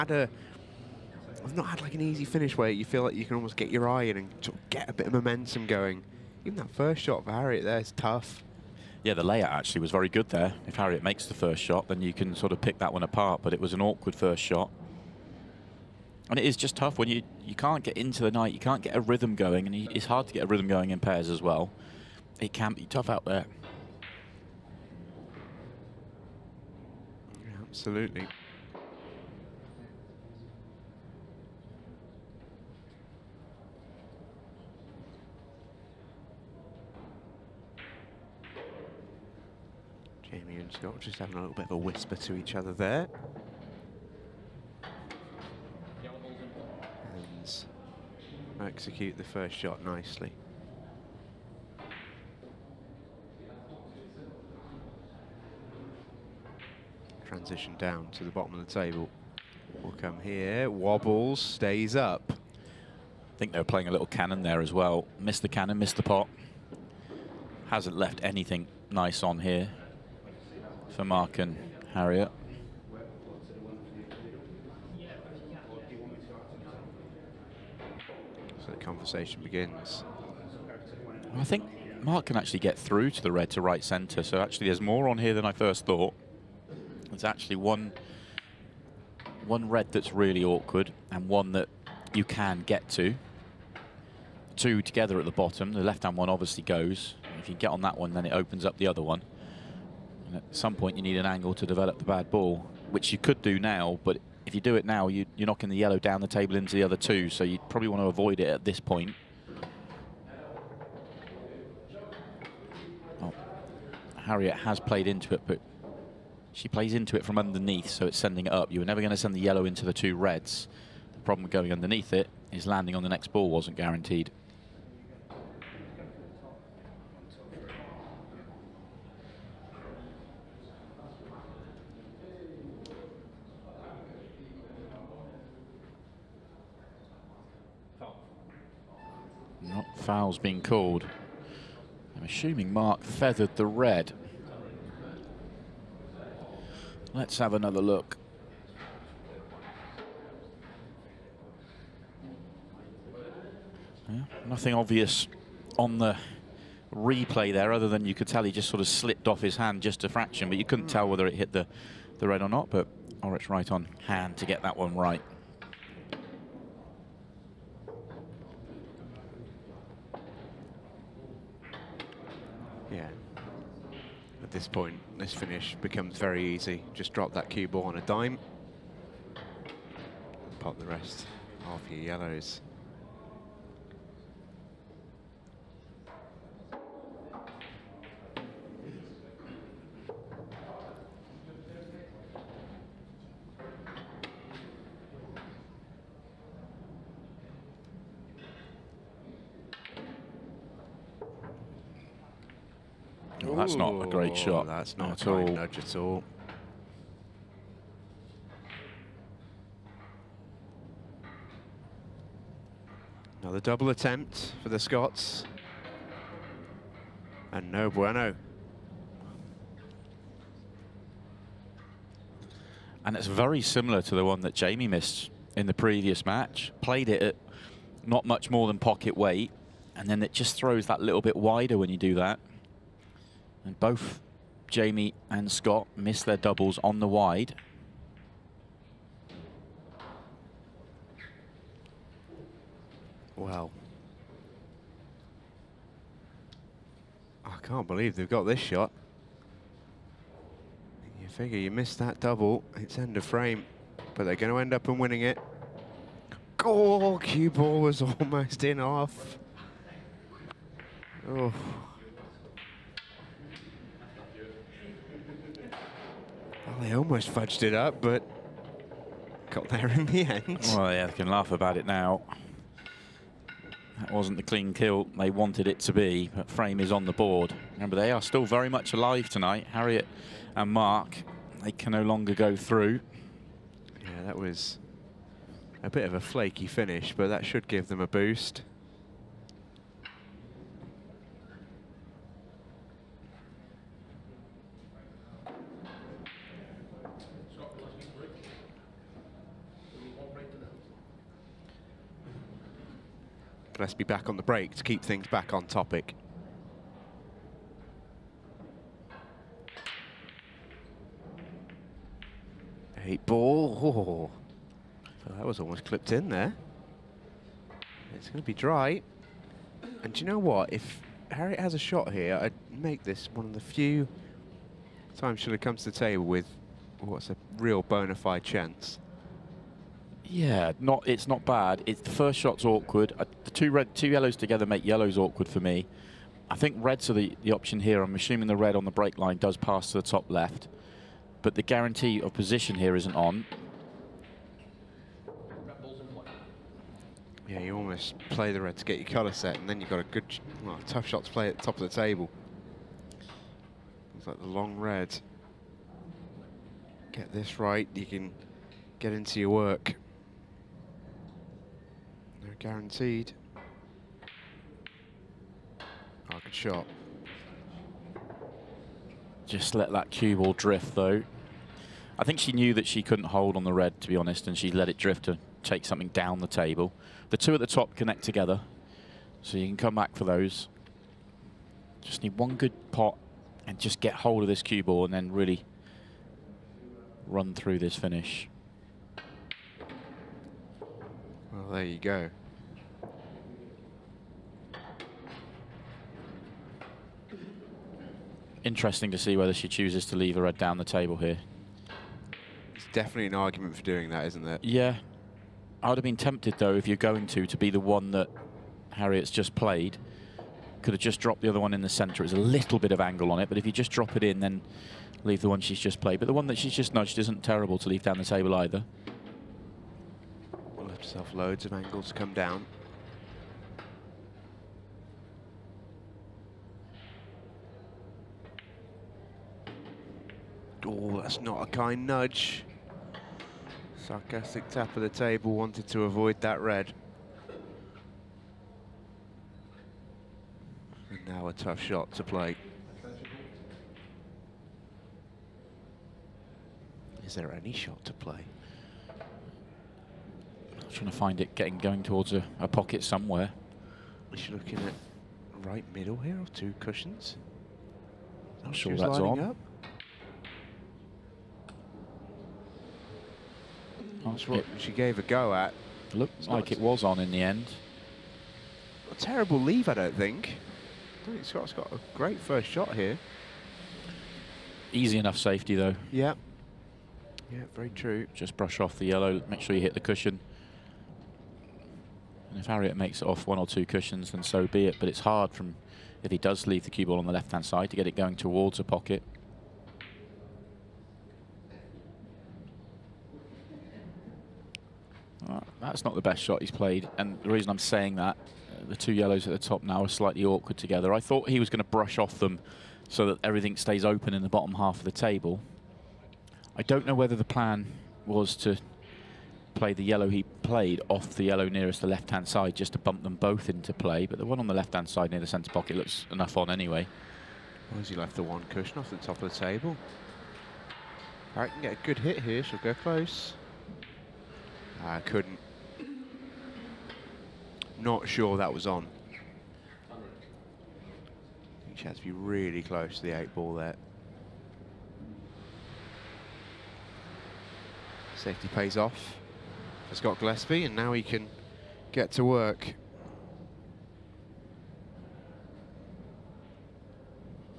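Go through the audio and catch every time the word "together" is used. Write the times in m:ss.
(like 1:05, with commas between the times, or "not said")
1:34, 5:34, 6:18, 8:20.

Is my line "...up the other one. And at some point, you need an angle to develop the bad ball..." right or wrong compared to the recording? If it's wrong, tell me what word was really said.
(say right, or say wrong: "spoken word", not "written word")
right.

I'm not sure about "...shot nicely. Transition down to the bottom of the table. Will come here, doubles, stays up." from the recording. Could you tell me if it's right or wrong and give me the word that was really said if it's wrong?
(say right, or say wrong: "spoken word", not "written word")
wrong: "wobbles", not "doubles".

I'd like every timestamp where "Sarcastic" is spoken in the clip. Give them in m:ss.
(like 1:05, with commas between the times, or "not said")
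7:13.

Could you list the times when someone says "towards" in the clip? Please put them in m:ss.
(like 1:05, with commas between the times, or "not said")
7:32, 8:08.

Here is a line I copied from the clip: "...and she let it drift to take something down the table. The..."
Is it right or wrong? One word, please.
right.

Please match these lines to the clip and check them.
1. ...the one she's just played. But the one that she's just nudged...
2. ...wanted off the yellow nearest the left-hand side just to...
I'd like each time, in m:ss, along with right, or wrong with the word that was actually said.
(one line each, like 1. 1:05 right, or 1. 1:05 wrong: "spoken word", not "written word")
1. 6:55 right
2. 8:30 wrong: "played", not "wanted".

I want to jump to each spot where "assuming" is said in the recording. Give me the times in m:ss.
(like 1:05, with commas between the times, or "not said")
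2:22, 5:38.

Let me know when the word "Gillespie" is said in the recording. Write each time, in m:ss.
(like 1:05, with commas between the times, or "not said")
5:03, 9:00.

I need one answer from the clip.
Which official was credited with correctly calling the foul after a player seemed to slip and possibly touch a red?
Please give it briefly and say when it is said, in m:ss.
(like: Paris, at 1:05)
Orich, at 2:43.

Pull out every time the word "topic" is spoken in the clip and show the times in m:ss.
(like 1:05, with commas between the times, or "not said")
5:05.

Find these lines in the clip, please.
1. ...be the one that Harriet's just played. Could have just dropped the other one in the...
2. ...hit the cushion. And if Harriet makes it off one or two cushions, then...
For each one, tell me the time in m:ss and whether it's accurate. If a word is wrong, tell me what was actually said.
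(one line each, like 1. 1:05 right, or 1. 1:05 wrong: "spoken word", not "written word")
1. 6:47 right
2. 7:59 right.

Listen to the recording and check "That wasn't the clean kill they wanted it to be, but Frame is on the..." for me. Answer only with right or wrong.
right.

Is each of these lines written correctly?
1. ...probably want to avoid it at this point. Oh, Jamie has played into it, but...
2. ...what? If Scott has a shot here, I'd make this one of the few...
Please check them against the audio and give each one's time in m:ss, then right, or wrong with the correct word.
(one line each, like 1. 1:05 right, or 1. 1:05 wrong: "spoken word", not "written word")
1. 1:47 wrong: "Harriet", not "Jamie"
2. 5:20 wrong: "Harriet", not "Scott".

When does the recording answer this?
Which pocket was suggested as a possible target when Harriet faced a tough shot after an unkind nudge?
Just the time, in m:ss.
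7:35.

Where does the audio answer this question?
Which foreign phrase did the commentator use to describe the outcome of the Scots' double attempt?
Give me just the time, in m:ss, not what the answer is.
3:37.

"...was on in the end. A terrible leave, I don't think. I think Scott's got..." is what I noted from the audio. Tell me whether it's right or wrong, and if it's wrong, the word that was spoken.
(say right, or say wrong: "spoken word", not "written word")
right.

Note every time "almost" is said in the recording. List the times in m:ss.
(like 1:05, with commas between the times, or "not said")
0:03, 4:18, 4:26, 5:15, 5:47.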